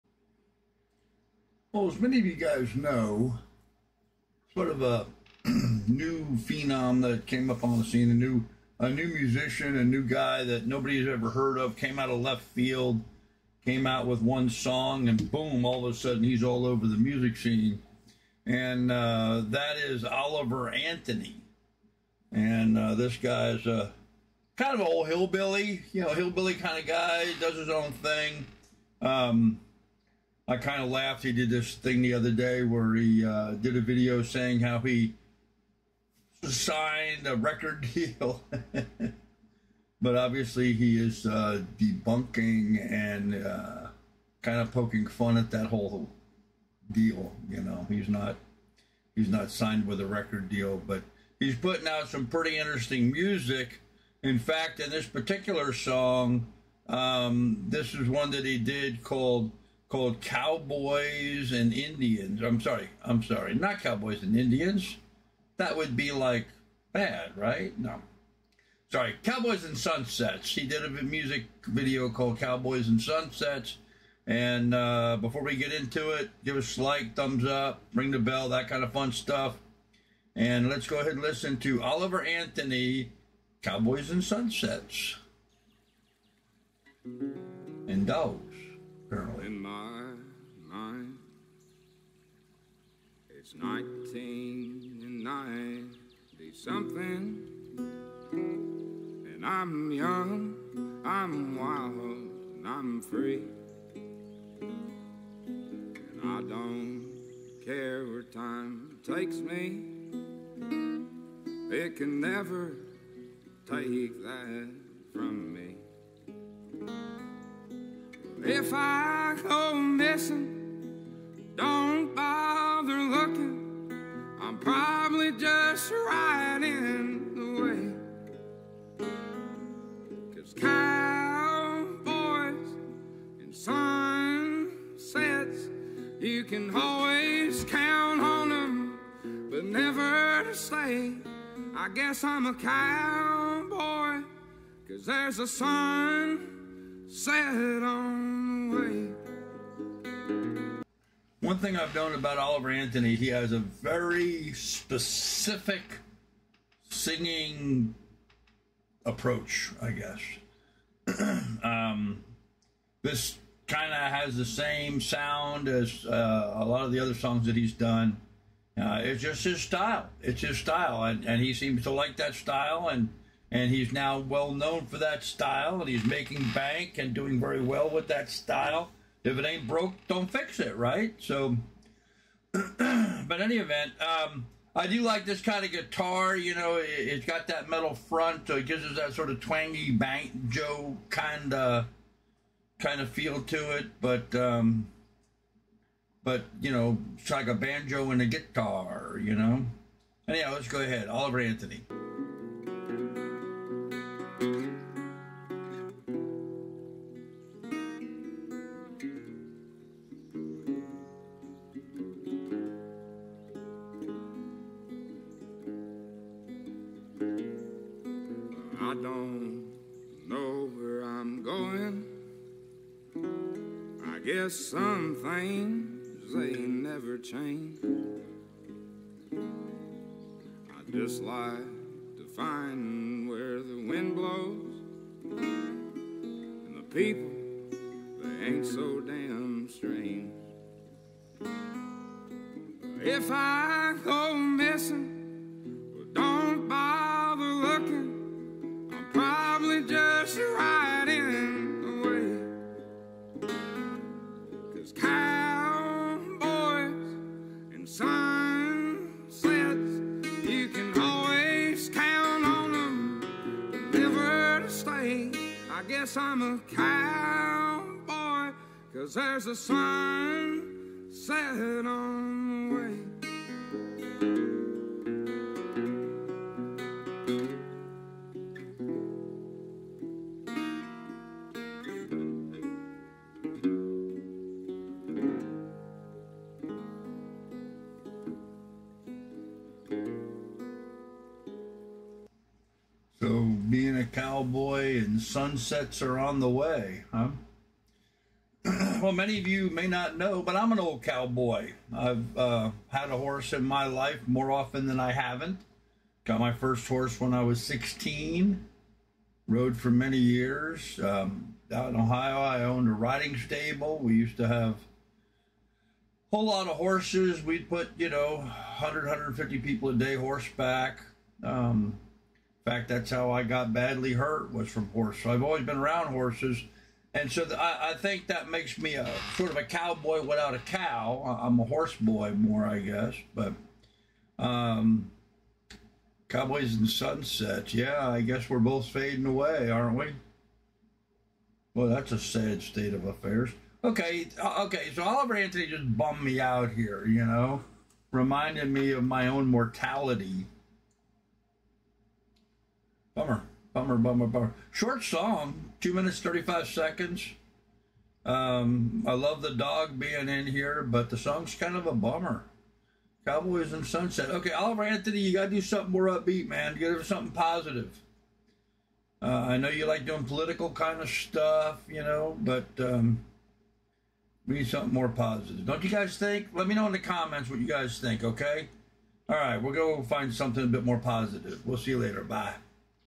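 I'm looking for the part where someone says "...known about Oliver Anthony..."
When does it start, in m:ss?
2:31.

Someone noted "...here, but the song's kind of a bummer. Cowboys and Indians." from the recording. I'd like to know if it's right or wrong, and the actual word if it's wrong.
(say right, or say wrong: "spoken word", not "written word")
wrong: "Sunset", not "Indians".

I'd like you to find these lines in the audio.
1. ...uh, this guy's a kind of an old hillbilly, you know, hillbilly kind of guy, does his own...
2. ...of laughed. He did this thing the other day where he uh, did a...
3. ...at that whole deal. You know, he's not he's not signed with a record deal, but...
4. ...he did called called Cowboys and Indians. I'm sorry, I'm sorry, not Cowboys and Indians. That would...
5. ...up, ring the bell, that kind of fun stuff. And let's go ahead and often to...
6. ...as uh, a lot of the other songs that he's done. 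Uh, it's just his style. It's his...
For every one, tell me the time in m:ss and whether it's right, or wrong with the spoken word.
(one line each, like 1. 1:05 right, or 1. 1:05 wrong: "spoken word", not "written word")
1. 0:22 right
2. 0:30 right
3. 0:45 right
4. 0:58 right
5. 1:17 wrong: "listen", not "often"
6. 2:45 right.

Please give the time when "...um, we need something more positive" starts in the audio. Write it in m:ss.
6:12.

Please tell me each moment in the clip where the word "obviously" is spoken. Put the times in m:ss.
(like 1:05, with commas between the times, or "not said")
0:40.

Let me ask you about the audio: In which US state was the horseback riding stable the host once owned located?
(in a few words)
Ohio.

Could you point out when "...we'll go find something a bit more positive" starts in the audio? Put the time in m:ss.
6:19.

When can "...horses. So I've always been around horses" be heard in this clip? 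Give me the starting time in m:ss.
5:24.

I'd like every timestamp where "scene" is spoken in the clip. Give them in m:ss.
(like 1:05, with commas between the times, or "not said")
0:07, 0:17.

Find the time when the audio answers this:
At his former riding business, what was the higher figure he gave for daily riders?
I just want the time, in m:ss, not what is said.
5:19.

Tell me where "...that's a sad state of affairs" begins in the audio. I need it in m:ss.
5:41.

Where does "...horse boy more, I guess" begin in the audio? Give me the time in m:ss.
5:31.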